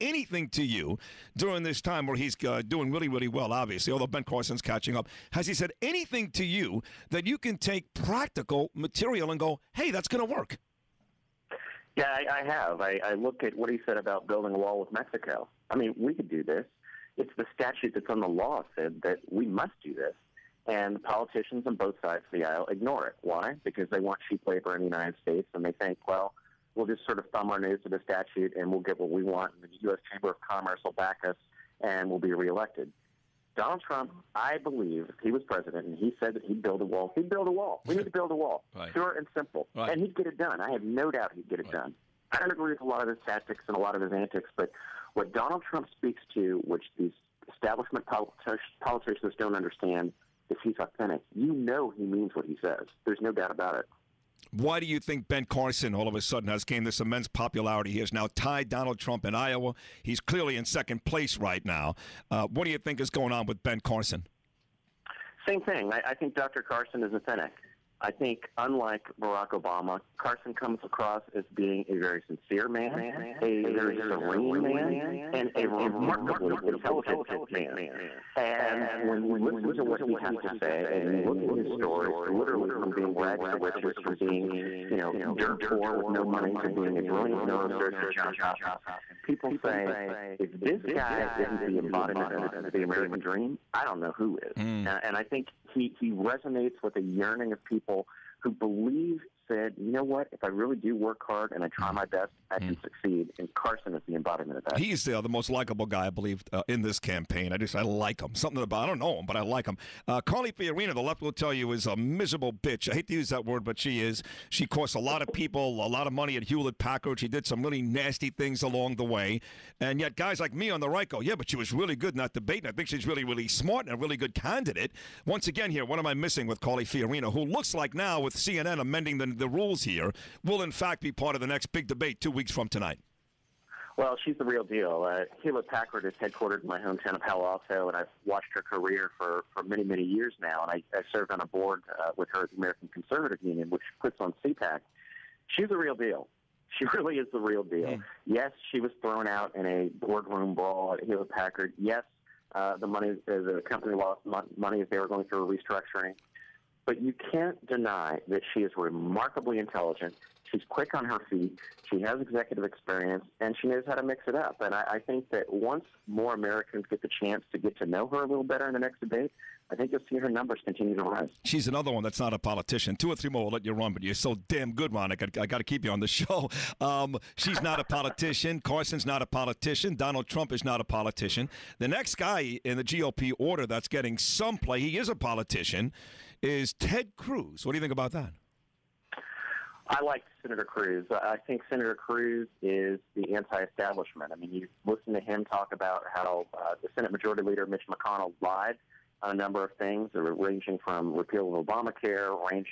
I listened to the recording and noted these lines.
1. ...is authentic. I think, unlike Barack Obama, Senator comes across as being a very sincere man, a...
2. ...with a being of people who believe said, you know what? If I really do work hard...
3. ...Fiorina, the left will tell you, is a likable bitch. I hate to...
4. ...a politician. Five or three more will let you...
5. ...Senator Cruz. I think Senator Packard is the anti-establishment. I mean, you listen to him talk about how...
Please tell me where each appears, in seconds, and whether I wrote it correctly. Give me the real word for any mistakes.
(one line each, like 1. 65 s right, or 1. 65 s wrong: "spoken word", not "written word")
1. 67 s wrong: "Carson", not "Senator"
2. 96 s wrong: "yearning", not "being"
3. 110 s wrong: "miserable", not "likable"
4. 172 s wrong: "Two", not "Five"
5. 190 s wrong: "Cruz", not "Packard".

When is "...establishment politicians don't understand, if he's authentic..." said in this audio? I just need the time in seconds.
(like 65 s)
47 s.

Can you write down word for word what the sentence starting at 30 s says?
Chamber of Commerce will back us, and we'll be reelected.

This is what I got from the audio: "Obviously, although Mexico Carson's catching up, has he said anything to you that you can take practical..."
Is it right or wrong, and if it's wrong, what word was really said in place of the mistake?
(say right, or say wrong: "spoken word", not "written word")
wrong: "Ben", not "Mexico".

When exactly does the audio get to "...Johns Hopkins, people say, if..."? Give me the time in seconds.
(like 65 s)
88 s.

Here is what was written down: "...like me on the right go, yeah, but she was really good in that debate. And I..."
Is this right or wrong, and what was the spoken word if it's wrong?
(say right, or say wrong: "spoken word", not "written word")
right.